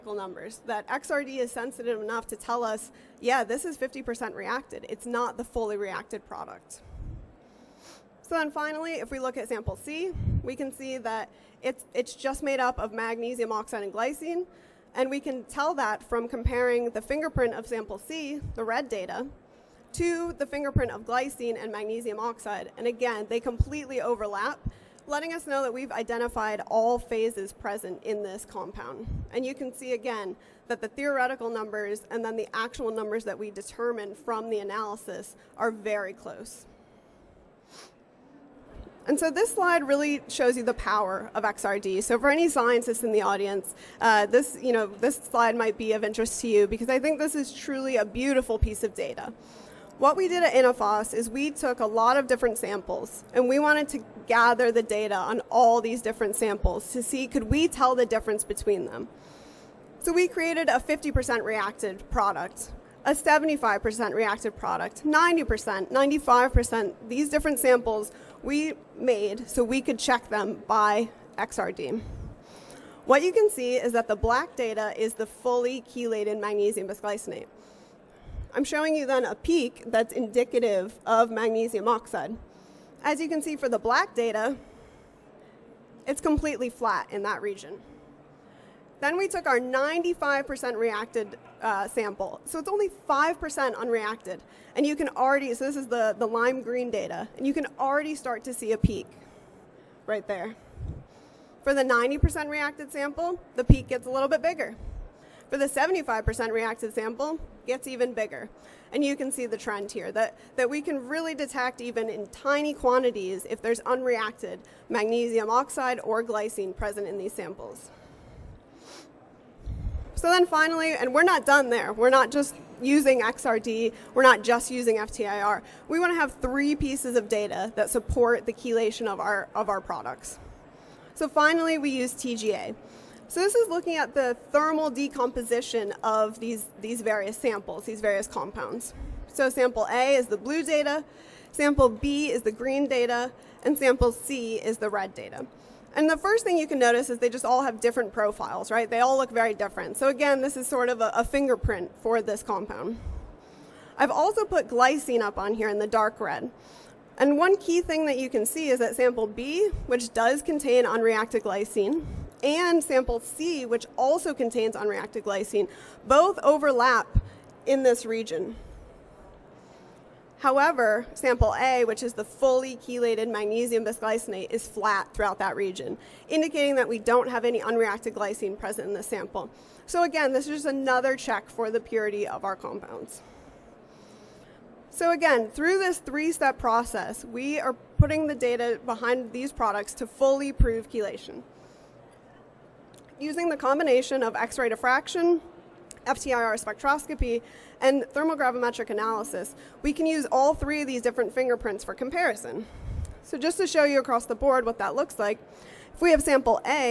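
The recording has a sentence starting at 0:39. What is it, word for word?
And so this slide really shows you the power of XRD.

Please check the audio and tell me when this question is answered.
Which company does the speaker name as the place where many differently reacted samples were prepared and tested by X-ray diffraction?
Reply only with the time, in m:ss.
0:50.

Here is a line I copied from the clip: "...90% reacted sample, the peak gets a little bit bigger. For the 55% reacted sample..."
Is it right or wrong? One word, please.
wrong.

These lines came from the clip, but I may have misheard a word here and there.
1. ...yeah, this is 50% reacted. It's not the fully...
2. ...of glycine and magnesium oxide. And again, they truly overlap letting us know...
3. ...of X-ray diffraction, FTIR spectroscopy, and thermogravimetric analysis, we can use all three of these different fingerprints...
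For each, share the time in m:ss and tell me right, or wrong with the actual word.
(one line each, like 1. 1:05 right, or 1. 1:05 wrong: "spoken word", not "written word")
1. 0:03 right
2. 0:20 wrong: "completely", not "truly"
3. 3:14 right.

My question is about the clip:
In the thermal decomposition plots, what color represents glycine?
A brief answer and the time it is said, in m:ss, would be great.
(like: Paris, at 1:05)
dark red, at 2:35.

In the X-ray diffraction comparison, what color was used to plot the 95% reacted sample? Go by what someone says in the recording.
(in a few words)
lime green.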